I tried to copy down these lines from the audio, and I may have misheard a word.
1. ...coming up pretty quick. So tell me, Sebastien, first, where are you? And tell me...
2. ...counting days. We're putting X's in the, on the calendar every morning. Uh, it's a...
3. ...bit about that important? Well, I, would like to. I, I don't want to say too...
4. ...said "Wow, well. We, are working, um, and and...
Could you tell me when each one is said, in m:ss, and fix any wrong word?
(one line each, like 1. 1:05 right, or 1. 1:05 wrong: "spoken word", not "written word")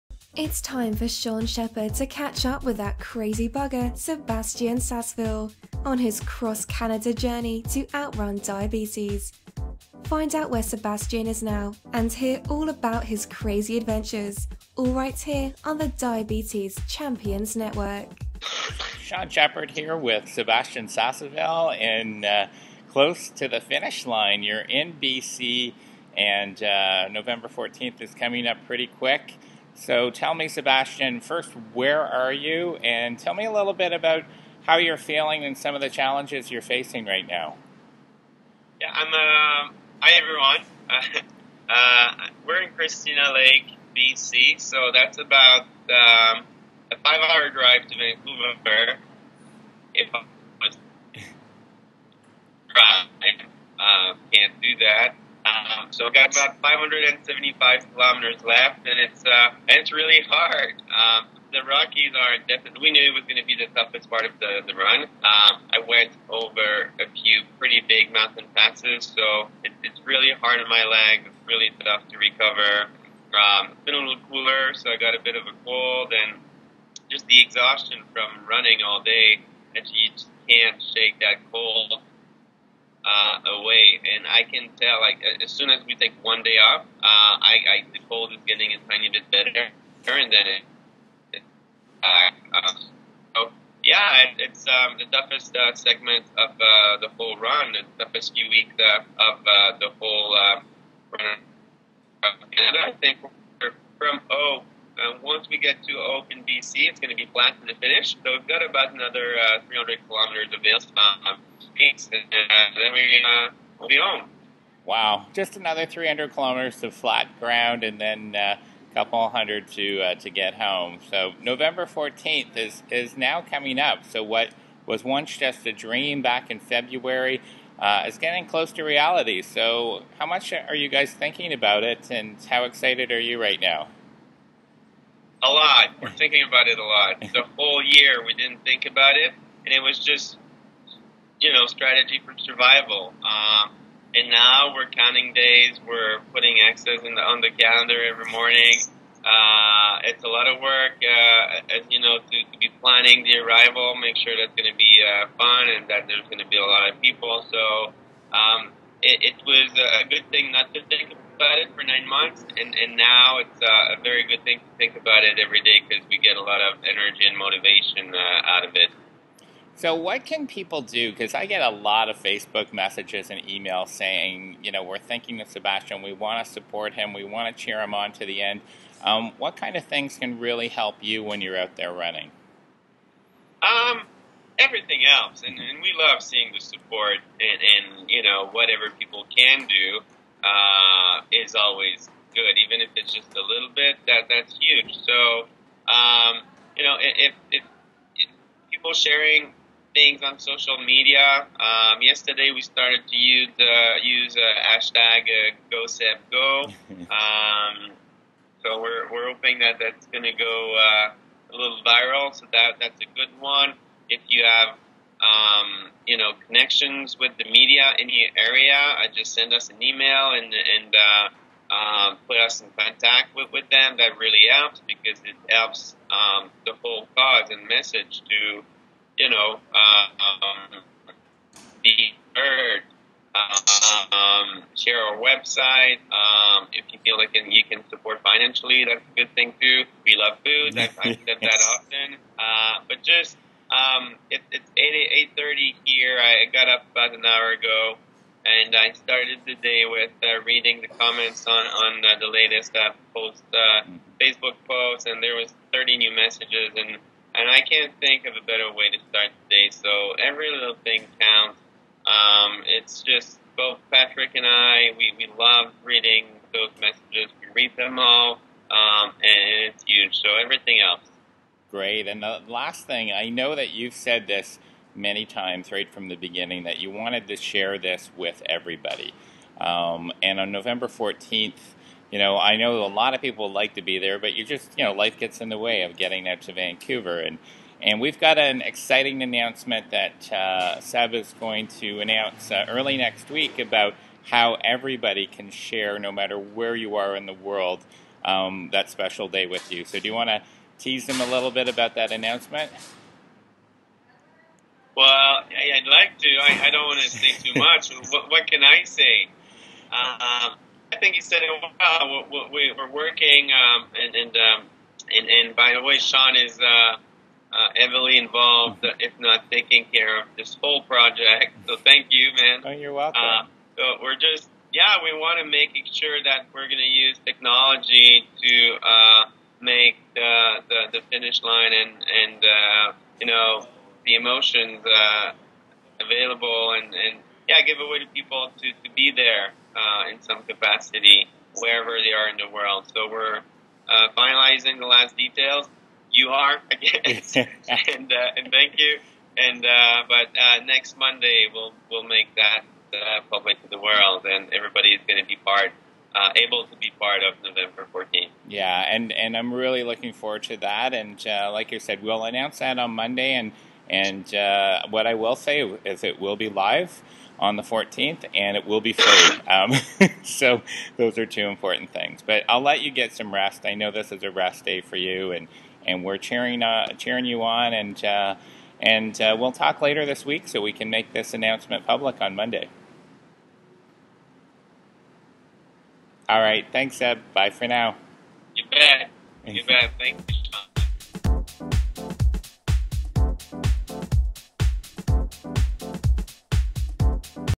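1. 0:28 right
2. 2:24 right
3. 5:01 wrong: "announcement", not "important"
4. 5:11 right.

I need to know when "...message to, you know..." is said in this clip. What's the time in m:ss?
3:47.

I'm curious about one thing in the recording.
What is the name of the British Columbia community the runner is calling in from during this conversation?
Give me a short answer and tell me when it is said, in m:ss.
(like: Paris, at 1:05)
Christina Lake, at 0:42.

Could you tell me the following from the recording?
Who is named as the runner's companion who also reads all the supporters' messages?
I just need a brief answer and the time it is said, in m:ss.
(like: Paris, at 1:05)
Patrick, at 4:23.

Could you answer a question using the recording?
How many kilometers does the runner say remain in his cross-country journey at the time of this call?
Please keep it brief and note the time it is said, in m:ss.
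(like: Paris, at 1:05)
575, at 0:56.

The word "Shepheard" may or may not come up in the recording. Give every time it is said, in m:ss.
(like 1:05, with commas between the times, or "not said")
0:01, 0:19.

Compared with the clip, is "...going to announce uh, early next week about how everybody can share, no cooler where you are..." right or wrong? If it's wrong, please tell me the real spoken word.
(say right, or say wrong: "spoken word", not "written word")
wrong: "matter", not "cooler".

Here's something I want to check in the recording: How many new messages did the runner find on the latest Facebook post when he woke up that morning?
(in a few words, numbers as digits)
30.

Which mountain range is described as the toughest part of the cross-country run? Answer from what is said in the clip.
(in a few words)
The Rockies.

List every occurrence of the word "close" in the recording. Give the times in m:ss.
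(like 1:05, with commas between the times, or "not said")
0:22, 2:08.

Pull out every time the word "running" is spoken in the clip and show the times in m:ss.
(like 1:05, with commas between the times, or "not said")
1:18, 3:01.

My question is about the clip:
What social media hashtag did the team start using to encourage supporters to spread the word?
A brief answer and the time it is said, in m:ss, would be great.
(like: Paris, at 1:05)
GoSebGo, at 3:25.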